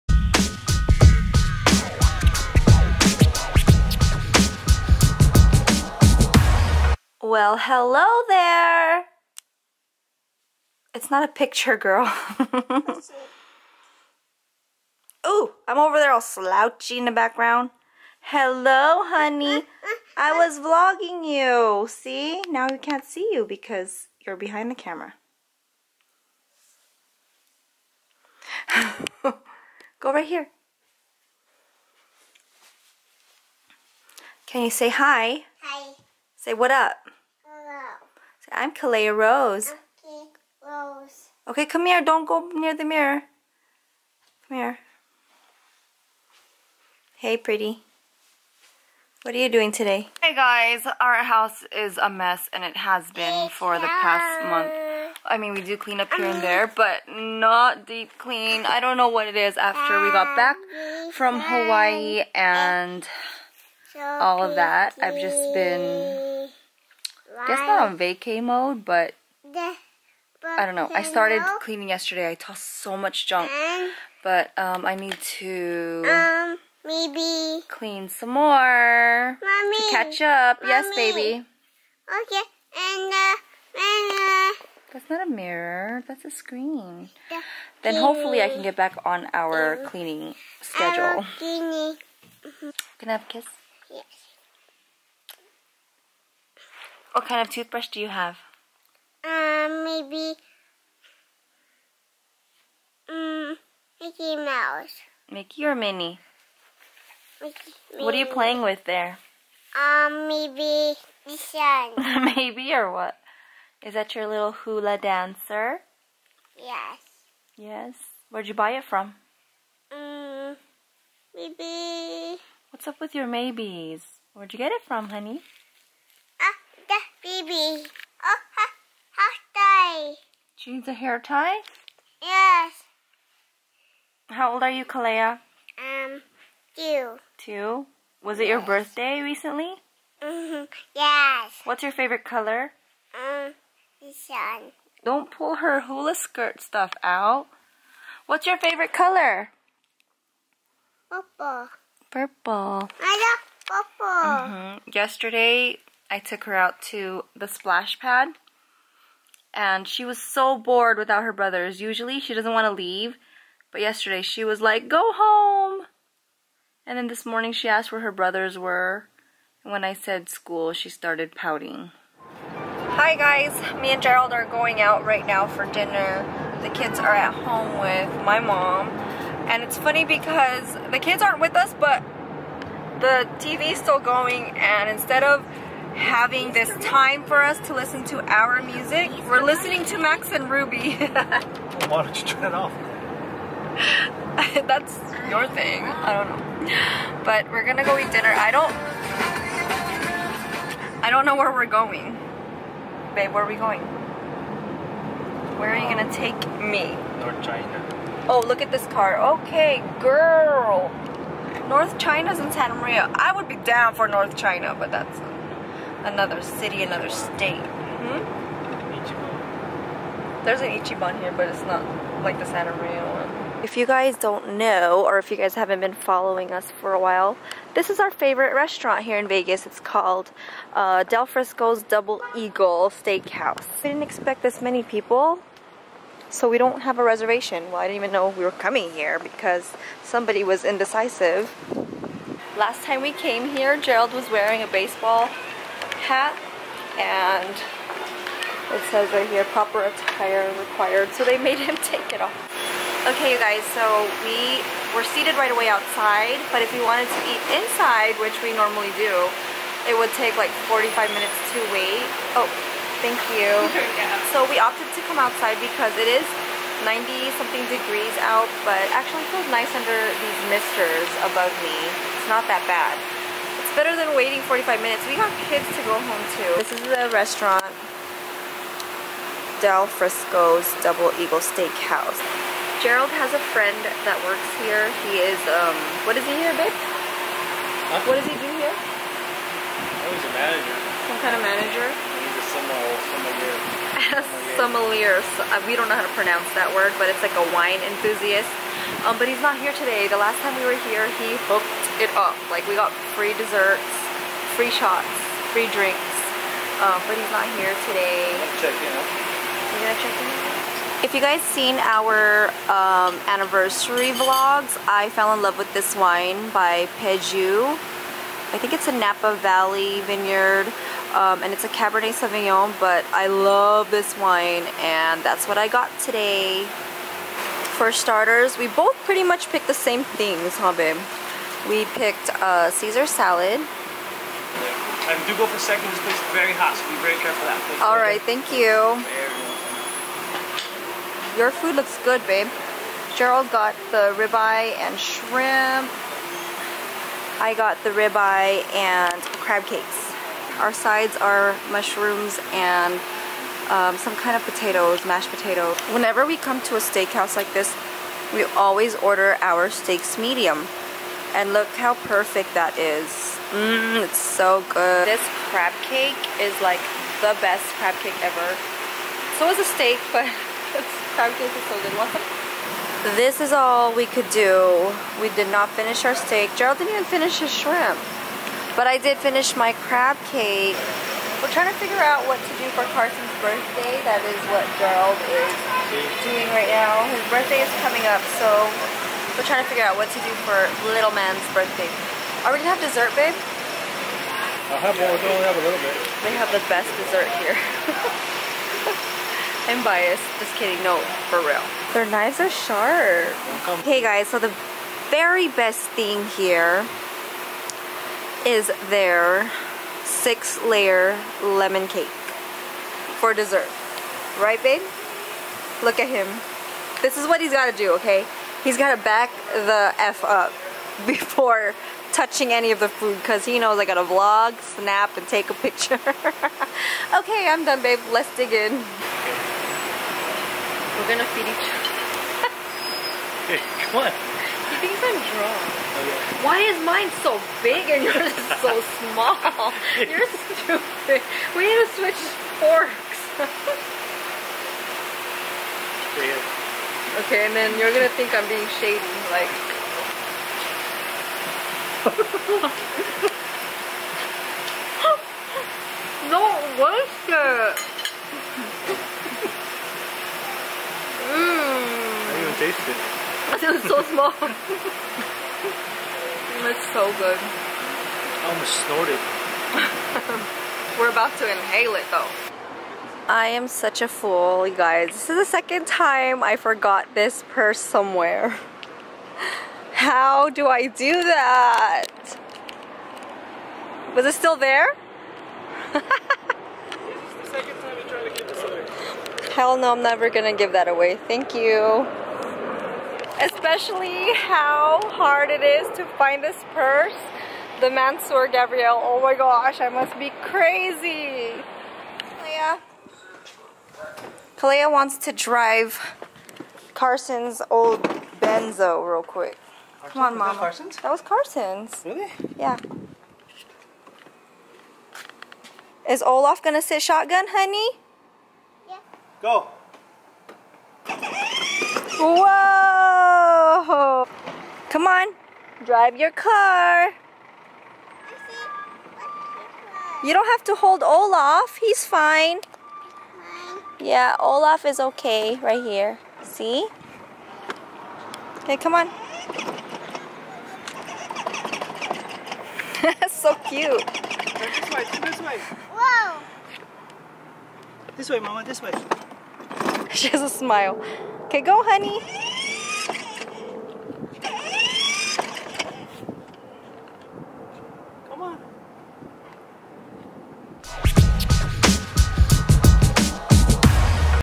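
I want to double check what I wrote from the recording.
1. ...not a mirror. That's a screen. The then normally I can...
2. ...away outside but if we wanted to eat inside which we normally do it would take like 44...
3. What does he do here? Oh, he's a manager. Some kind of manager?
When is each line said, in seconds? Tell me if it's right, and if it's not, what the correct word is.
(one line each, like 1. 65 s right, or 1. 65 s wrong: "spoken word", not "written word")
1. 85 s wrong: "hopefully", not "normally"
2. 255 s wrong: "45", not "44"
3. 288 s right.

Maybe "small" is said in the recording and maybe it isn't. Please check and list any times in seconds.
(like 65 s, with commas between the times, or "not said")
439 s, 464 s.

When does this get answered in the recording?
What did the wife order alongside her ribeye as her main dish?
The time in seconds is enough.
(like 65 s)
349 s.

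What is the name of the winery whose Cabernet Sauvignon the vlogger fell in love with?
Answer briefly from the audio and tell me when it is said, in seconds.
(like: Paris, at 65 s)
Peju, at 317 s.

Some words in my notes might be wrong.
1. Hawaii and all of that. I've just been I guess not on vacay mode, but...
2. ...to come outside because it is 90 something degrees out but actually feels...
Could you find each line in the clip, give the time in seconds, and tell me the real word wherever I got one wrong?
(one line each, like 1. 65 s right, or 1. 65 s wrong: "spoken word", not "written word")
1. 61 s right
2. 264 s right.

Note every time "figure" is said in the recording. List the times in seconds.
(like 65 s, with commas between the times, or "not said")
381 s, 389 s.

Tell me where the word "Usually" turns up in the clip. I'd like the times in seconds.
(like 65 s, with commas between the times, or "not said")
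161 s.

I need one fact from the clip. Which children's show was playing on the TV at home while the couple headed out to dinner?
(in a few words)
Max and Ruby.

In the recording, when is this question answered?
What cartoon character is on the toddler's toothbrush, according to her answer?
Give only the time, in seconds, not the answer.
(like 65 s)
104 s.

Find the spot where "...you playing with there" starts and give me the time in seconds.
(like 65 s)
108 s.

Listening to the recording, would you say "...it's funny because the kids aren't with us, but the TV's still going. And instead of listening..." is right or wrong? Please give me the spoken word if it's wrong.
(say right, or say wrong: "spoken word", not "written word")
wrong: "having", not "listening".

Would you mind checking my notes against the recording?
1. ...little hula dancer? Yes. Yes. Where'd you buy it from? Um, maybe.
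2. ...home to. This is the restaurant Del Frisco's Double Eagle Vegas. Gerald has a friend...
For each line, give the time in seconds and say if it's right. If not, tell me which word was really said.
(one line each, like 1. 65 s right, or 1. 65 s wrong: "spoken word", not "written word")
1. 114 s right
2. 275 s wrong: "Steakhouse", not "Vegas".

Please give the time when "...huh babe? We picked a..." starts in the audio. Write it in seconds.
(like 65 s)
330 s.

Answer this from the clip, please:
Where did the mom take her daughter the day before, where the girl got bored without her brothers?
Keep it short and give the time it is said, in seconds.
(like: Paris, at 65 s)
Splash pad, at 157 s.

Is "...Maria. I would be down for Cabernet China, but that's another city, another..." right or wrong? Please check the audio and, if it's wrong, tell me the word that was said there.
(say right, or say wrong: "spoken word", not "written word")
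wrong: "North", not "Cabernet".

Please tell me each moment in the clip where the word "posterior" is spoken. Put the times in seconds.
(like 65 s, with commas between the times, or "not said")
not said.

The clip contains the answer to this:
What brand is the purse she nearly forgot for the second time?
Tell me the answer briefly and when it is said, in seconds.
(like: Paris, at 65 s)
Mansur Gavriel, at 497 s.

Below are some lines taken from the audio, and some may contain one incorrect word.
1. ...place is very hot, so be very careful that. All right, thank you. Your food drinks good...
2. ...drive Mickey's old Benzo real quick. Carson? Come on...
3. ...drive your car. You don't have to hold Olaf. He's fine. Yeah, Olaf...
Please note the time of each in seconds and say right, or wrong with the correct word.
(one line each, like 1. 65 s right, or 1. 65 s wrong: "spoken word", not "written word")
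1. 336 s wrong: "looks", not "drinks"
2. 505 s wrong: "Carson", not "Mickey"
3. 525 s right.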